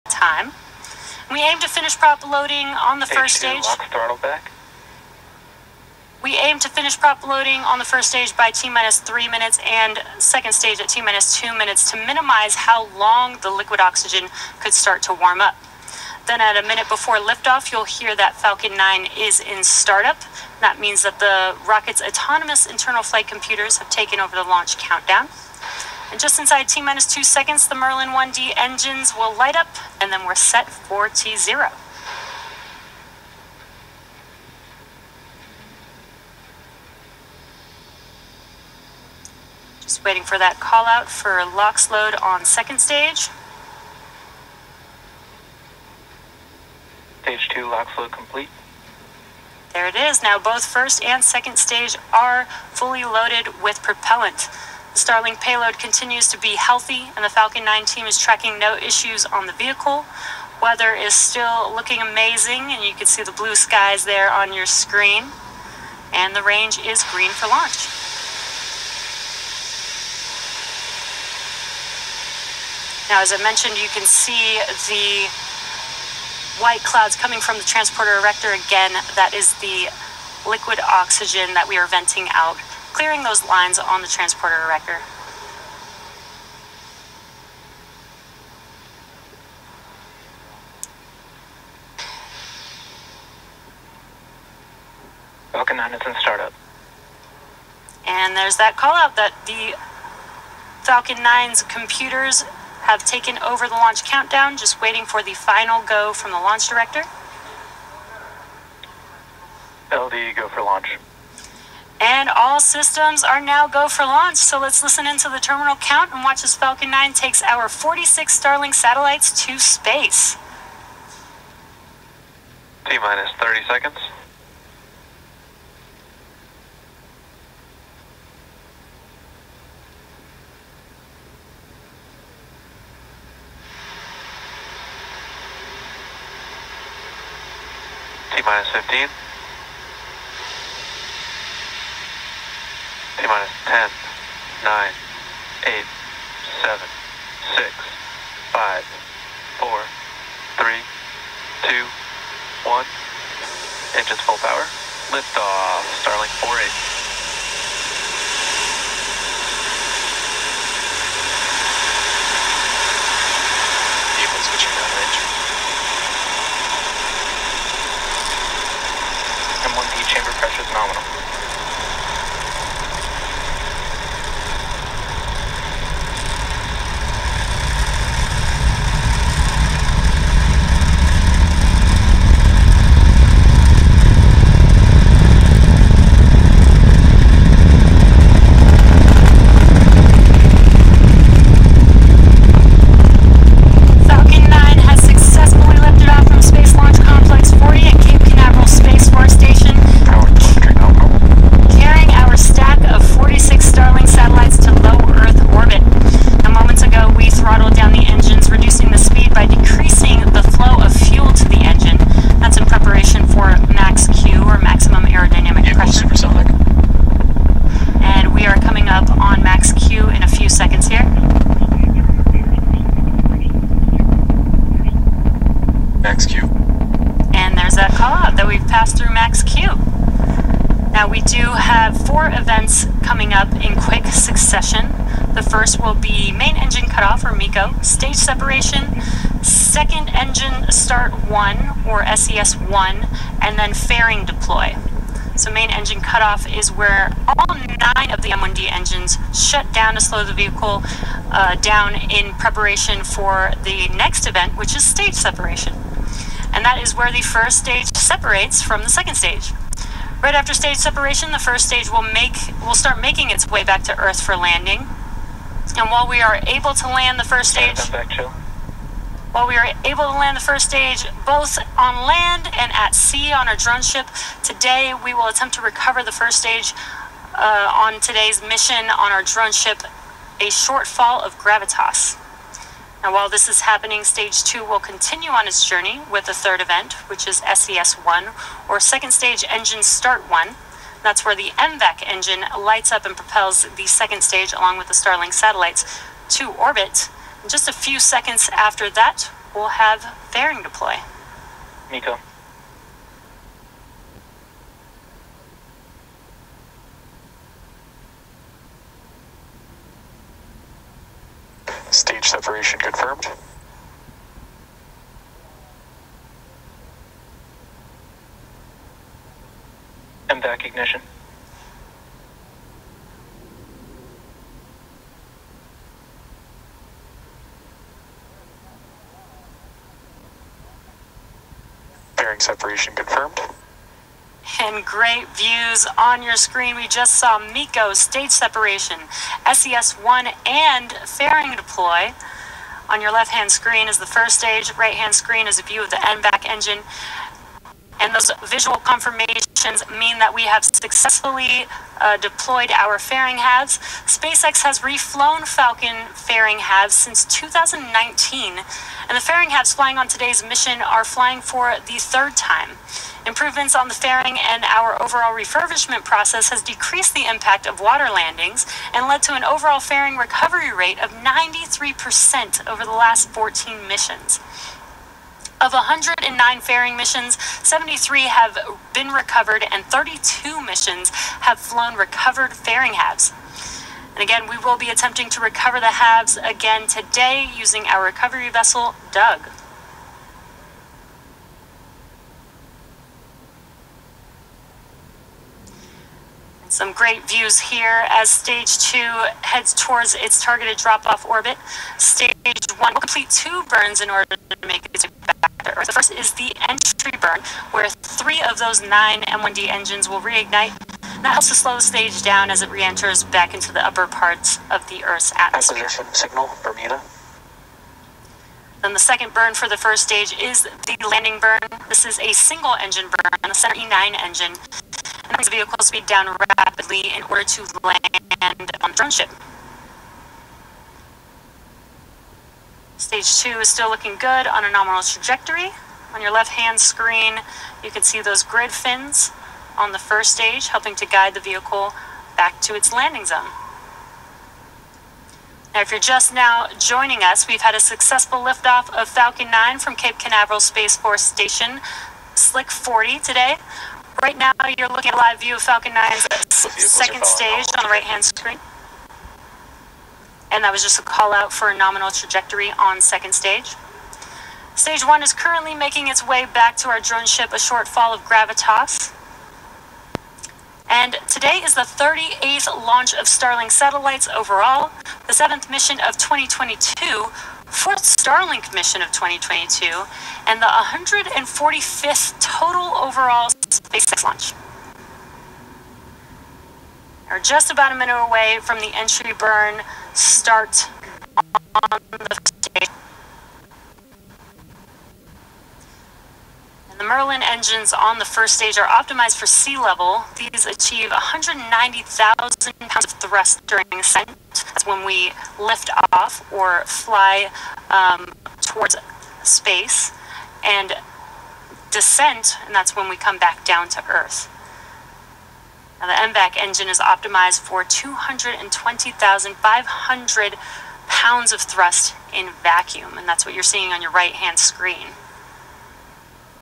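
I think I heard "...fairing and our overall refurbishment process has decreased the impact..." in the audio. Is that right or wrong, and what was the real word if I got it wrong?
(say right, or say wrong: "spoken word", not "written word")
right.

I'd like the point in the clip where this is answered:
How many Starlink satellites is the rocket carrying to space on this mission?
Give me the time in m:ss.
1:57.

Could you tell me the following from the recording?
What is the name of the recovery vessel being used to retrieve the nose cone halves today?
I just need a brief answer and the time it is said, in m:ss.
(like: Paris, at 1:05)
Doug, at 6:29.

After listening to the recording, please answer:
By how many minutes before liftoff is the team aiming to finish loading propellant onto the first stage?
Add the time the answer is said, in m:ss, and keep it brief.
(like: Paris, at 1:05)
3 minutes, at 0:08.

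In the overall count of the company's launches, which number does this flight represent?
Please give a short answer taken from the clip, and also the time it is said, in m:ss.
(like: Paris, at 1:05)
145th, at 8:00.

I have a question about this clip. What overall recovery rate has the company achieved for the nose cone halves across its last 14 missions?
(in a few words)
93%.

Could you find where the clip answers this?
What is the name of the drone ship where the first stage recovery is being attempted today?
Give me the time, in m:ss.
4:40.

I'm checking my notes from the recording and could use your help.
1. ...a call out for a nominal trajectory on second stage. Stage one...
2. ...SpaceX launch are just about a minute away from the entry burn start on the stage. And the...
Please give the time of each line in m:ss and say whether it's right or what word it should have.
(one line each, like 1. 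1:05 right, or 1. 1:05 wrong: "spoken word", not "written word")
1. 7:40 right
2. 8:03 right.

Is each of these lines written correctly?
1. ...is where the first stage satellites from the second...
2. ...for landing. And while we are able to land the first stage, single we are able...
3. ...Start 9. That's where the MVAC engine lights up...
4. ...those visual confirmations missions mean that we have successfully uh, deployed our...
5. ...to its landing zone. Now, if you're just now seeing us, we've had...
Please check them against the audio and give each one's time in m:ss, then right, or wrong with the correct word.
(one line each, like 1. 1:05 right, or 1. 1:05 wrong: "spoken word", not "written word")
1. 4:16 wrong: "separates", not "satellites"
2. 4:24 wrong: "while", not "single"
3. 4:49 wrong: "1", not "9"
4. 5:48 right
5. 7:22 wrong: "joining", not "seeing".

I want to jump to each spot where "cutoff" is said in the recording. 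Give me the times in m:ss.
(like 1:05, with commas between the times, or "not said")
3:56, 4:06.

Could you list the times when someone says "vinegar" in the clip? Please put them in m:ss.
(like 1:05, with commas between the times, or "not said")
not said.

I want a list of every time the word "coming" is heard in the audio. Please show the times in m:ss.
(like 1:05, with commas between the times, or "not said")
1:17, 3:53.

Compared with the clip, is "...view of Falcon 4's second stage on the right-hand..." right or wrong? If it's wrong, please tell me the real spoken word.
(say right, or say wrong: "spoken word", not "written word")
wrong: "9", not "4".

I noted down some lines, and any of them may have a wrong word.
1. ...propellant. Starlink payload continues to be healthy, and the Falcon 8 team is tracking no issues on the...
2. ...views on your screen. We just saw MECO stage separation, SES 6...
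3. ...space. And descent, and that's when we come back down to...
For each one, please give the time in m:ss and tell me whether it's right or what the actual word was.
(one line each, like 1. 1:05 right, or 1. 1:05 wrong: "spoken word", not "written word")
1. 0:53 wrong: "9", not "8"
2. 5:35 wrong: "1", not "6"
3. 8:29 right.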